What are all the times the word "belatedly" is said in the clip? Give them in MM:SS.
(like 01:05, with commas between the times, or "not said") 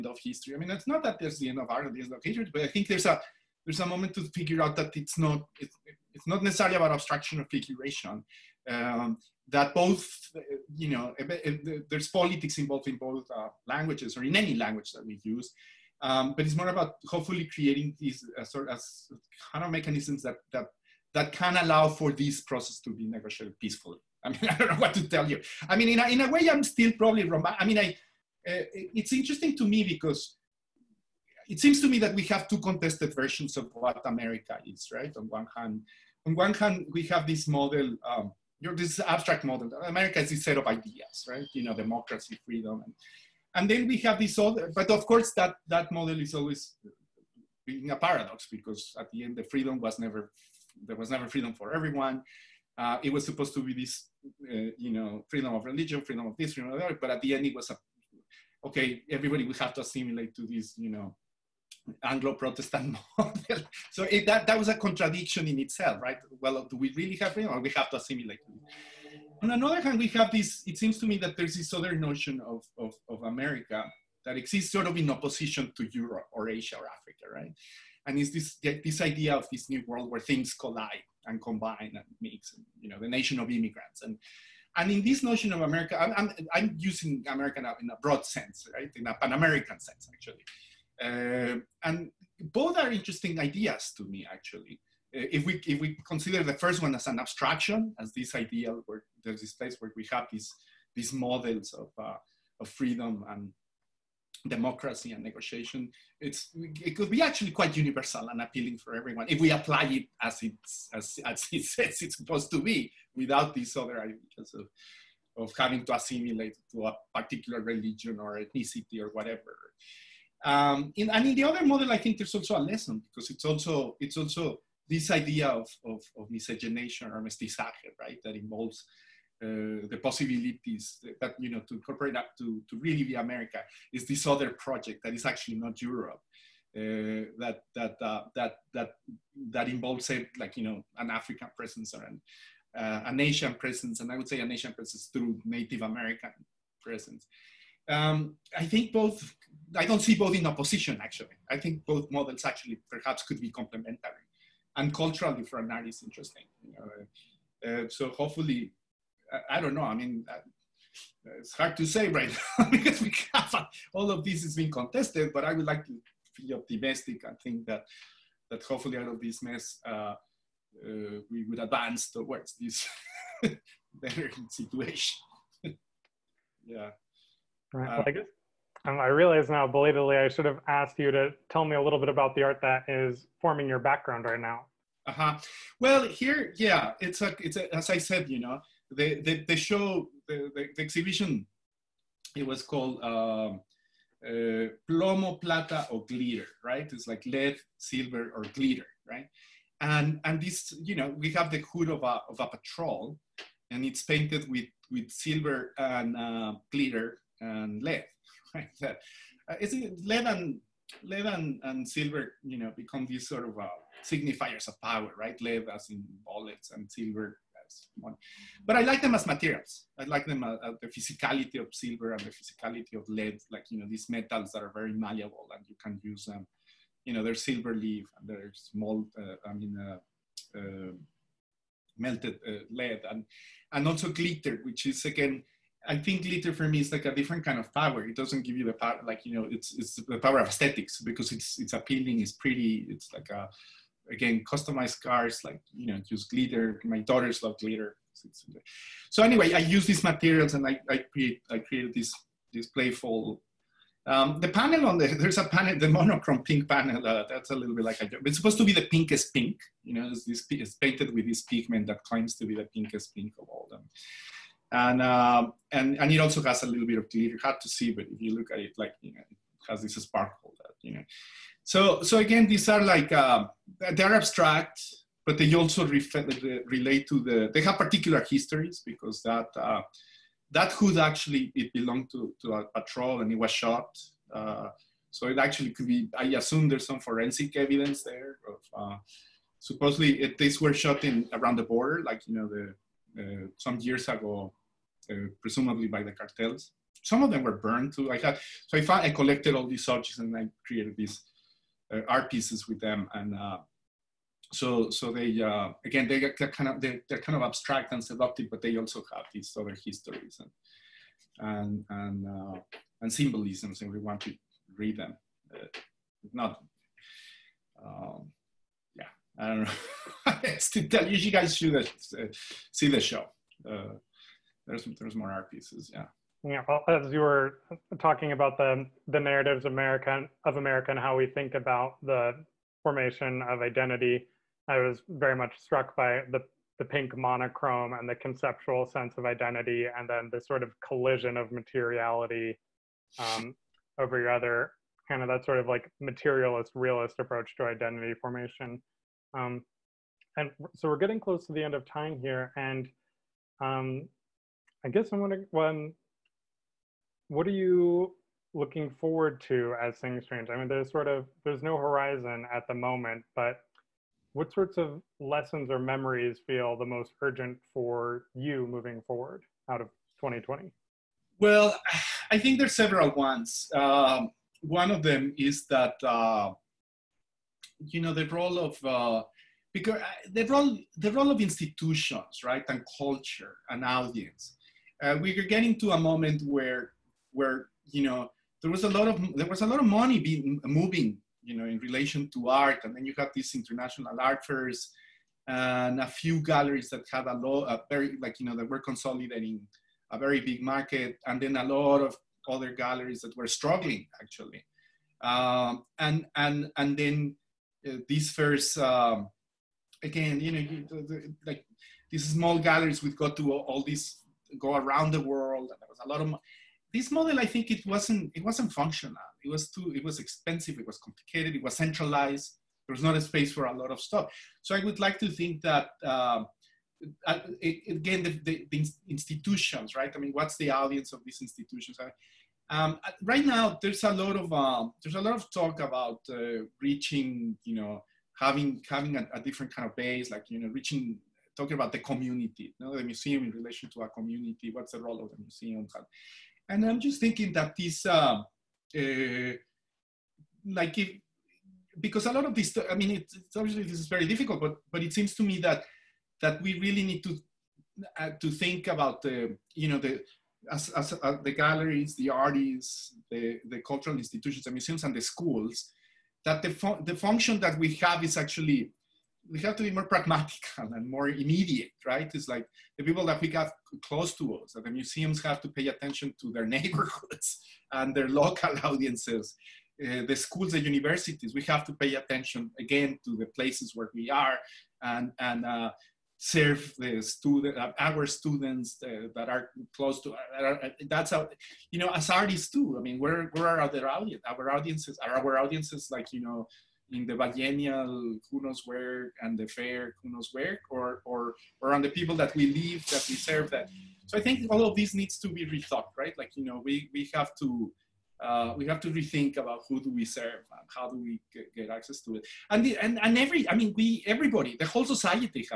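02:59.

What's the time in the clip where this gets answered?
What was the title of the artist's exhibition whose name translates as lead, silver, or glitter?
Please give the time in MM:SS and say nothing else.
03:14.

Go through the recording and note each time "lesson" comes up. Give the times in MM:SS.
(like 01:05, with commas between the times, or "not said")
02:02, 06:05.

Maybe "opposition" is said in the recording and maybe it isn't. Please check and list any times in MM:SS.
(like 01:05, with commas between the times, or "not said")
01:15, 02:30.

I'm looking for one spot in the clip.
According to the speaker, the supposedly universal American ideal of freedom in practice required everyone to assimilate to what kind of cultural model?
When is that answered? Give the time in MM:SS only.
01:02.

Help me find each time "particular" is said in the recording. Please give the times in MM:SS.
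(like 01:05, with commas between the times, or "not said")
01:57, 04:37.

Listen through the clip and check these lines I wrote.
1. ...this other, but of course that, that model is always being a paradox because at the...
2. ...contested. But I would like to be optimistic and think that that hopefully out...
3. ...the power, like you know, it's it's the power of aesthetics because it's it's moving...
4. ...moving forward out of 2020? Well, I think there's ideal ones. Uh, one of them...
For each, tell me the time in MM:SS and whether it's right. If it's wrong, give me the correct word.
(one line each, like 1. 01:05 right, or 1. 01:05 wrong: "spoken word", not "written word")
1. 00:44 right
2. 02:44 right
3. 03:58 wrong: "appealing", not "moving"
4. 06:08 wrong: "several", not "ideal".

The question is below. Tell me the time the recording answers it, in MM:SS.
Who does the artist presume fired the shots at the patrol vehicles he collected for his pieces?
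04:56.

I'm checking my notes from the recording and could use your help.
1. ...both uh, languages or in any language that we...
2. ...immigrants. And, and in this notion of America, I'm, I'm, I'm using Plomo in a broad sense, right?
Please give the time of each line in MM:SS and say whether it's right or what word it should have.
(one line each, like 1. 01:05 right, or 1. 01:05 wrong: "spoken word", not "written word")
1. 00:12 right
2. 01:23 wrong: "America", not "Plomo".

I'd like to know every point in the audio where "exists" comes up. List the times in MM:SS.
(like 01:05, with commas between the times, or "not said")
01:14.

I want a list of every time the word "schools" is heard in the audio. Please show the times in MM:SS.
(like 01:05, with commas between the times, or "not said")
07:45, 08:00.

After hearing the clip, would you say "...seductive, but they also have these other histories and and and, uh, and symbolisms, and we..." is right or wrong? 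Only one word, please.
right.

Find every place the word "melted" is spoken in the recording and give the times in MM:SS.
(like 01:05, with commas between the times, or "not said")
03:52.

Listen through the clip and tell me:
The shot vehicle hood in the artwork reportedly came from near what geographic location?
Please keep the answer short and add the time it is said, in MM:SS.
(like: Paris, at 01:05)
the border, at 04:51.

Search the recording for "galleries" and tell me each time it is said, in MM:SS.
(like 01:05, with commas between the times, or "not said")
06:36, 06:42, 06:52, 07:41.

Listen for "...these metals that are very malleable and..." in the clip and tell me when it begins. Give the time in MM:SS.
03:43.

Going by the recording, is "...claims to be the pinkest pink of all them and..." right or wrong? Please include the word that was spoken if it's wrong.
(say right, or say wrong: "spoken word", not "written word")
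right.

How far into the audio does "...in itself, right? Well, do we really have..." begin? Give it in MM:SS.
01:05.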